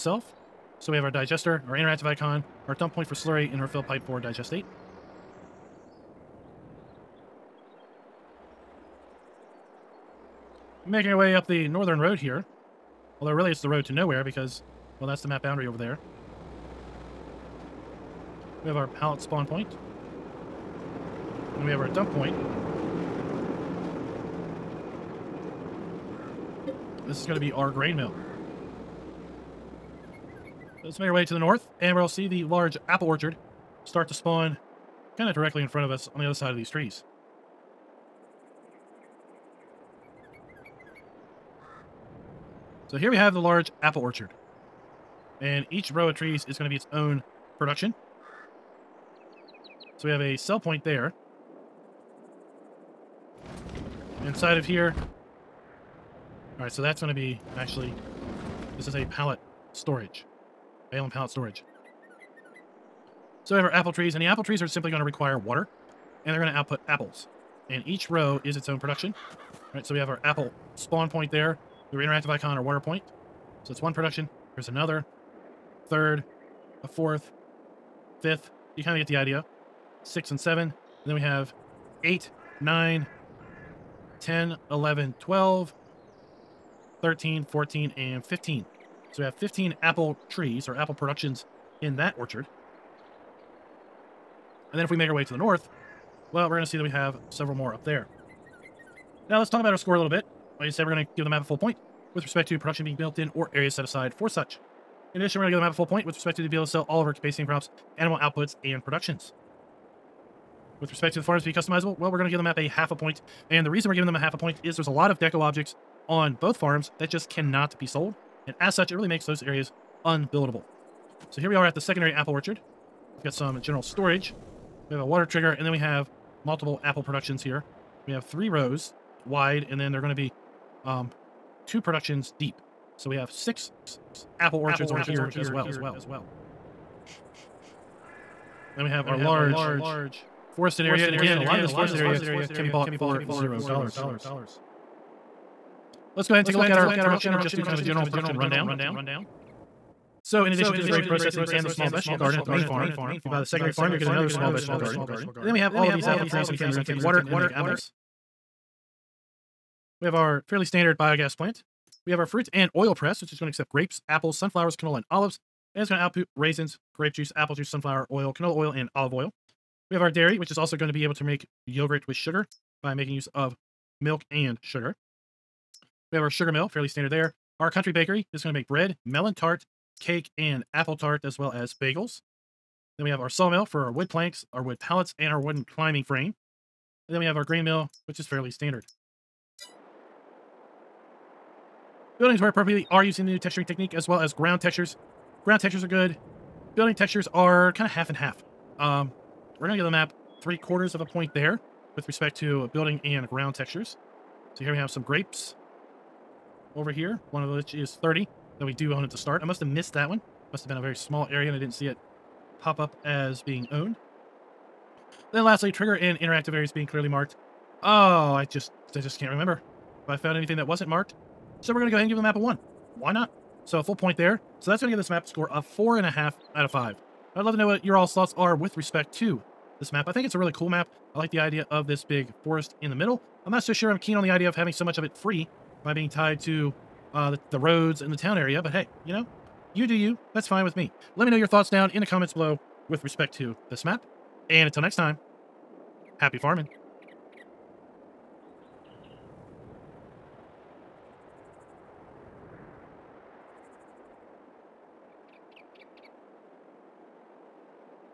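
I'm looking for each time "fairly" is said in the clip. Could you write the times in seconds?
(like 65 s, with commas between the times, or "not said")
160 s, 176 s, 188 s.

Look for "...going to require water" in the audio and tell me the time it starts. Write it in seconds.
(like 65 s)
64 s.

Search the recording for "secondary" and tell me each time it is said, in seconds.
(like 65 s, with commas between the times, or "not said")
121 s, 153 s.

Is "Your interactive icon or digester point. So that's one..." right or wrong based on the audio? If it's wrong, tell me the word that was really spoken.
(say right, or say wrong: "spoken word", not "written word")
wrong: "water", not "digester".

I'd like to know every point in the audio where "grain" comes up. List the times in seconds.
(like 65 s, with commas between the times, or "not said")
27 s, 187 s.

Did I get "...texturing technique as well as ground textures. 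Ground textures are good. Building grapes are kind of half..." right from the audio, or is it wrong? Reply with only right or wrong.
wrong.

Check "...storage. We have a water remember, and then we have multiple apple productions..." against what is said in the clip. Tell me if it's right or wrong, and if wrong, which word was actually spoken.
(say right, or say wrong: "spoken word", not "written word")
wrong: "trigger", not "remember".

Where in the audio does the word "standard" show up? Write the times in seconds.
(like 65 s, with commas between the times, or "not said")
160 s, 176 s, 188 s.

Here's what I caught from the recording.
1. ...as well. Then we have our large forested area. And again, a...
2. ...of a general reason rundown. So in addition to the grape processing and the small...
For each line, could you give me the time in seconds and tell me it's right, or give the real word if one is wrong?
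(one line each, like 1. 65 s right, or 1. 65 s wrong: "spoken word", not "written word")
1. 135 s right
2. 147 s wrong: "production", not "reason".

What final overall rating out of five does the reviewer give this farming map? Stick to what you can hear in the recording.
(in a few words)
4.5.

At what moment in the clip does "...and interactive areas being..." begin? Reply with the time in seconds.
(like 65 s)
215 s.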